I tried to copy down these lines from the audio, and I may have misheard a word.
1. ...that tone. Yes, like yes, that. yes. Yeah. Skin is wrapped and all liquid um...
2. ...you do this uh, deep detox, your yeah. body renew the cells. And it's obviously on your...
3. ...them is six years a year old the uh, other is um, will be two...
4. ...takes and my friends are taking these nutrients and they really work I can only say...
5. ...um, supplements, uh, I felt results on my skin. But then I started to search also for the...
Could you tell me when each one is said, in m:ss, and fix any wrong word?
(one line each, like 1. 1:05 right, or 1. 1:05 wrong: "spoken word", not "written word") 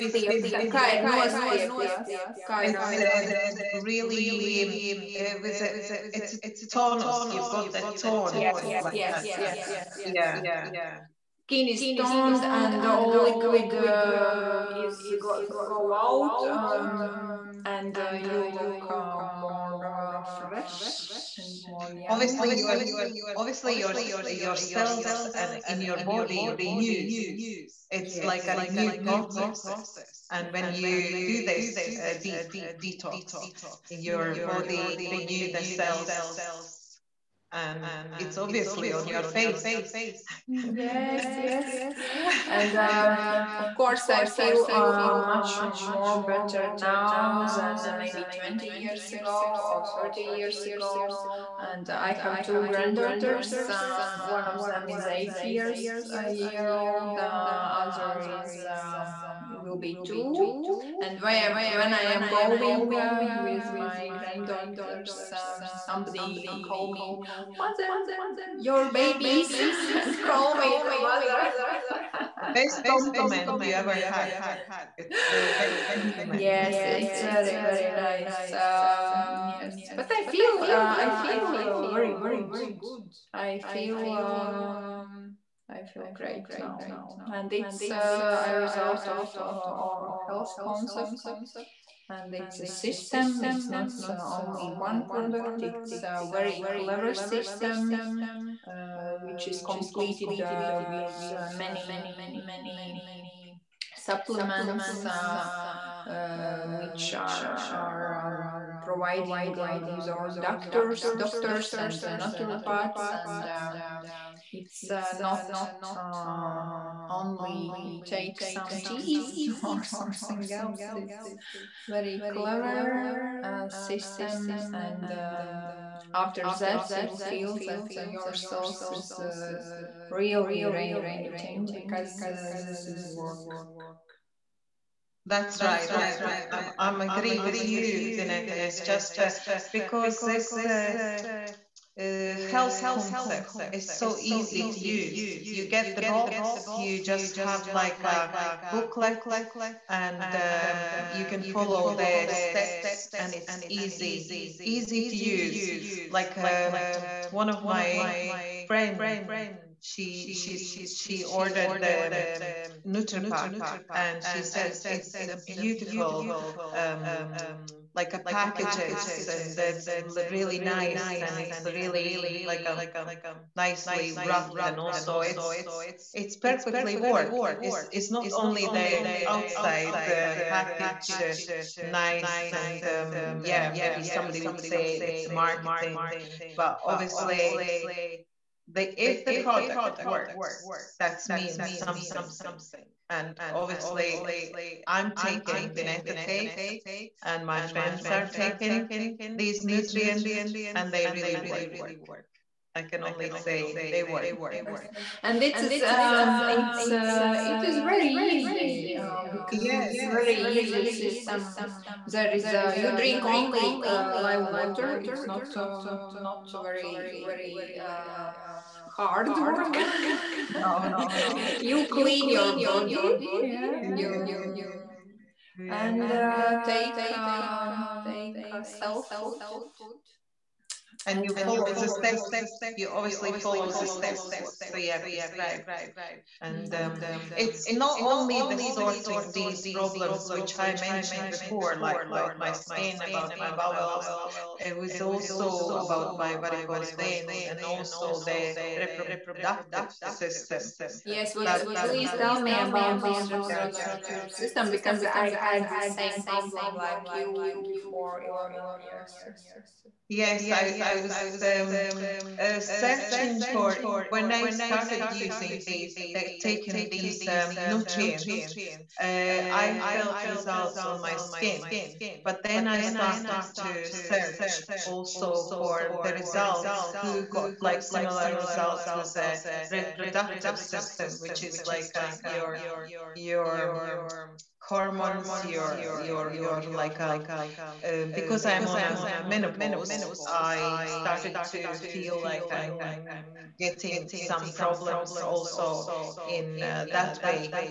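1. 0:07 wrong: "toned", not "wrapped"
2. 0:30 right
3. 0:54 wrong: "eight", not "six"
4. 3:16 right
5. 4:27 wrong: "nutrients", not "supplements".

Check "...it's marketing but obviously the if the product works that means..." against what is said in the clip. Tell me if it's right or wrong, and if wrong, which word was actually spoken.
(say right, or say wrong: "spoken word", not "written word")
right.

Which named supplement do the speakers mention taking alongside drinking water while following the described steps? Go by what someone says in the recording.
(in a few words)
Cellfood.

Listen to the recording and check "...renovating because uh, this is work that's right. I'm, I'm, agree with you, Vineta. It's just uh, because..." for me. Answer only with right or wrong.
right.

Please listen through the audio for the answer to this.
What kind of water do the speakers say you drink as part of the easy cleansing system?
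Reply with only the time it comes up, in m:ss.
3:34.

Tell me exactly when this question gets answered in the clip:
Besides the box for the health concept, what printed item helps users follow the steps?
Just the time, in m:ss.
2:28.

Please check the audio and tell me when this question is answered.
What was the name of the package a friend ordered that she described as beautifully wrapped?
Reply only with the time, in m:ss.
2:42.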